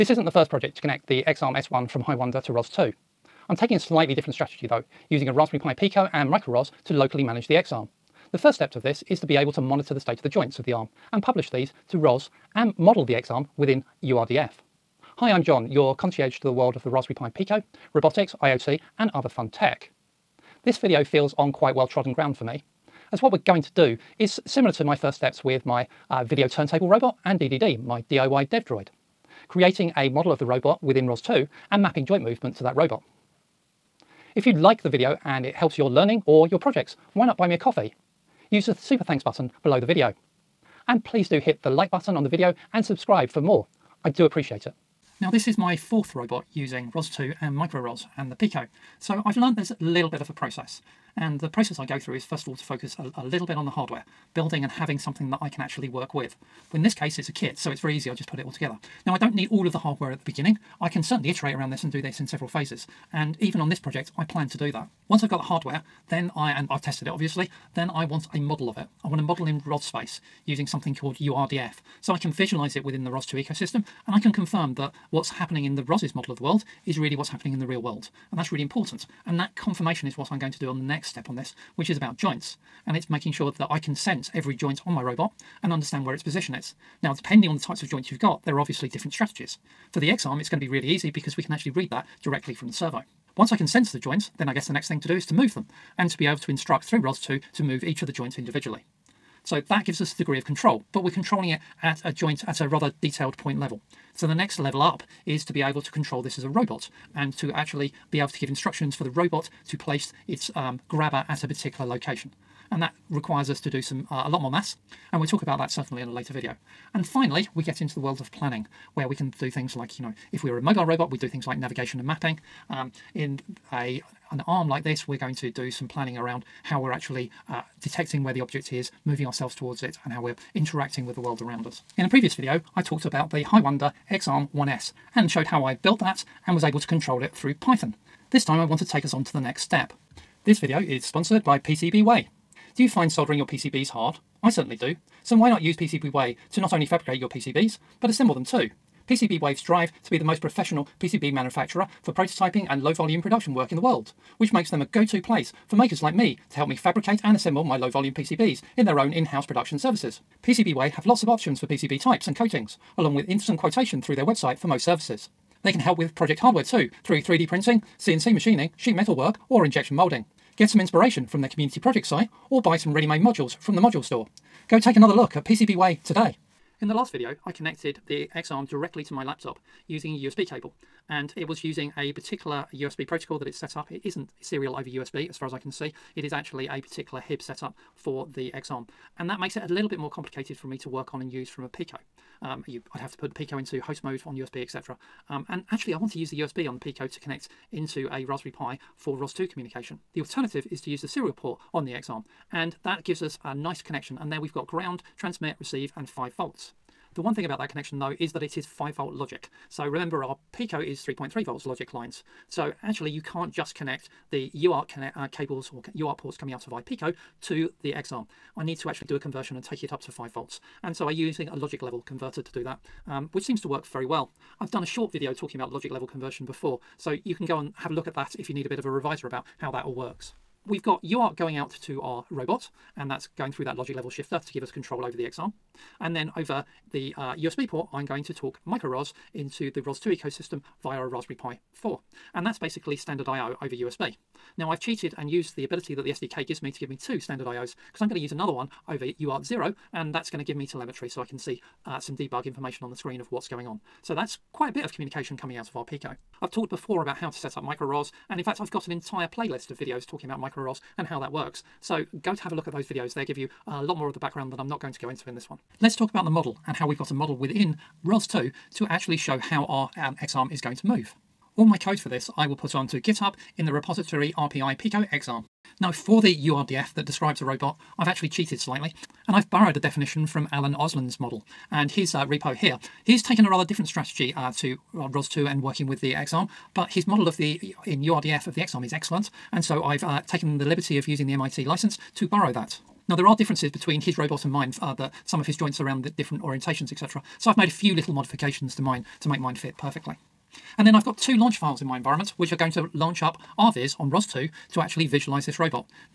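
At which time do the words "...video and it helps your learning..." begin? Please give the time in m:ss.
0:34.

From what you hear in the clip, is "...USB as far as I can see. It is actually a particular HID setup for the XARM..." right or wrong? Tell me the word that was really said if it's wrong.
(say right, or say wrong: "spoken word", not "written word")
right.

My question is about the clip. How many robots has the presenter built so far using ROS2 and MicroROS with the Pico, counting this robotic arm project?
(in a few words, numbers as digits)
4.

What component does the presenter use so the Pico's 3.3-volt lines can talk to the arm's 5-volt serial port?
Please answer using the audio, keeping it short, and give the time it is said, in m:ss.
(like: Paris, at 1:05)
Logic level converter, at 3:41.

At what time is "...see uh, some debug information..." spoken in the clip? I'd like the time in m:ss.
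4:11.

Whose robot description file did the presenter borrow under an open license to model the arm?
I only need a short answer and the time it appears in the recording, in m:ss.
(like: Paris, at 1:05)
Alan Olsen, at 4:40.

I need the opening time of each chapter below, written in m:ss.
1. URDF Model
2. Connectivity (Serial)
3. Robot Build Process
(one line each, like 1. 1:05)
1. 4:24
2. 2:59
3. 0:51.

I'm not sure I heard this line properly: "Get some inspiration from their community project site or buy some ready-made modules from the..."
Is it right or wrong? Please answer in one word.
right.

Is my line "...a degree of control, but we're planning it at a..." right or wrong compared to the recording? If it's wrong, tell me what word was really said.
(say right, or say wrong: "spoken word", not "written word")
wrong: "controlling", not "planning".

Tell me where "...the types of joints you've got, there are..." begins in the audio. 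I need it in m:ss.
1:27.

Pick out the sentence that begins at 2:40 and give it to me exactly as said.
PCBWay have lots of options for PCB types and coatings, along with instant quotation through their website for most services.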